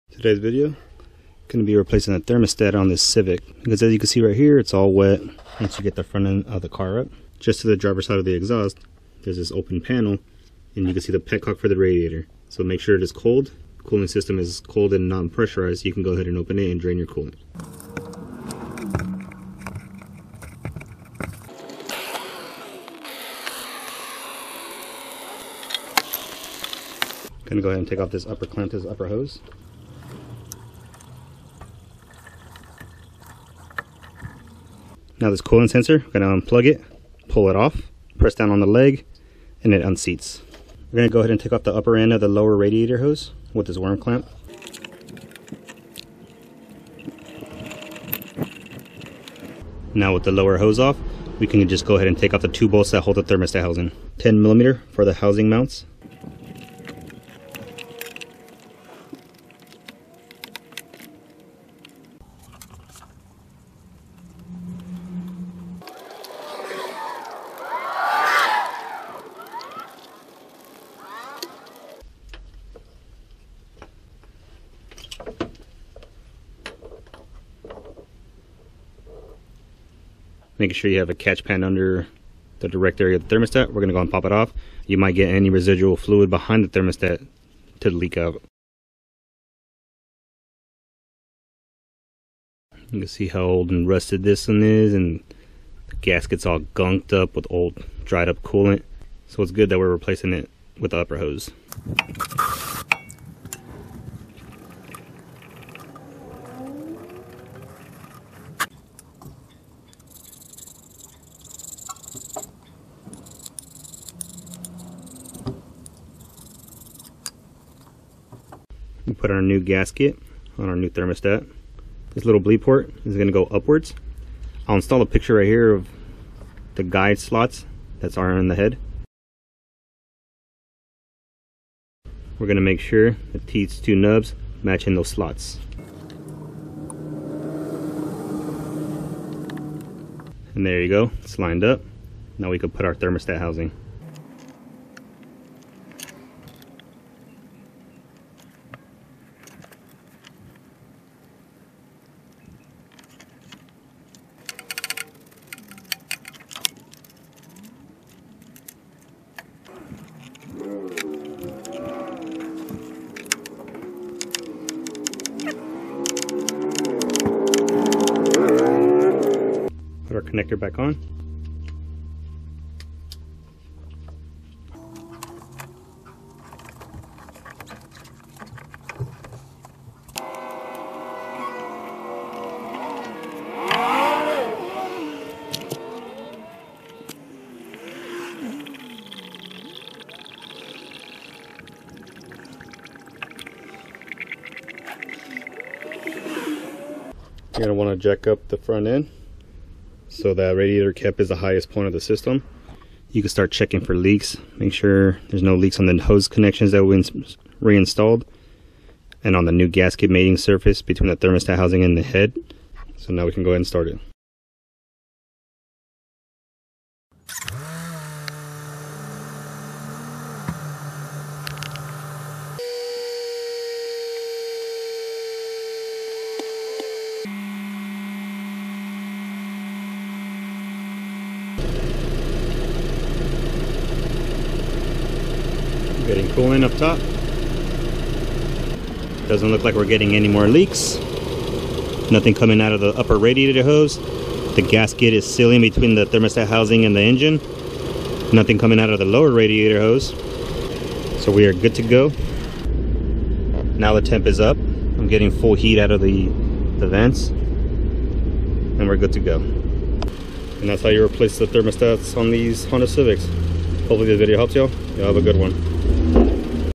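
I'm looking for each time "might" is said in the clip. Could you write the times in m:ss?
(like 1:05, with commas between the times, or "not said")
1:24.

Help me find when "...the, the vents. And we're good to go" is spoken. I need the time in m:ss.
4:16.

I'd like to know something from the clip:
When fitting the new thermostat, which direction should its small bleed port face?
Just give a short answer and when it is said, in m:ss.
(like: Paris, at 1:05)
Upwards, at 2:03.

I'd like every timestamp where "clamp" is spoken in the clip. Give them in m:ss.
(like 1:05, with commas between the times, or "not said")
0:28, 0:43.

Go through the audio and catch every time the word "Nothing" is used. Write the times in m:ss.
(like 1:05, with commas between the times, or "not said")
4:02, 4:08.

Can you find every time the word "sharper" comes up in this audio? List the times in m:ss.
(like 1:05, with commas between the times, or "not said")
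not said.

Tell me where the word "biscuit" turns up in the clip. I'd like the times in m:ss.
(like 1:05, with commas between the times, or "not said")
not said.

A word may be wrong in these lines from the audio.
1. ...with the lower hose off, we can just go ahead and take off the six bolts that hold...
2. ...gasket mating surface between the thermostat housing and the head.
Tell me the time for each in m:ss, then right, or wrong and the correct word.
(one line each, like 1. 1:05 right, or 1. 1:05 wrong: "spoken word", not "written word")
1. 0:50 wrong: "two", not "six"
2. 3:29 right.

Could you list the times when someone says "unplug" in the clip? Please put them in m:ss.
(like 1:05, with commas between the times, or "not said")
0:36.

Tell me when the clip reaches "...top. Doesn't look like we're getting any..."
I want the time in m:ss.
3:56.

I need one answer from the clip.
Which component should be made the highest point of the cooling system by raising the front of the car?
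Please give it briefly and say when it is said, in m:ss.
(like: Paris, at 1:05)
Radiator cap, at 3:20.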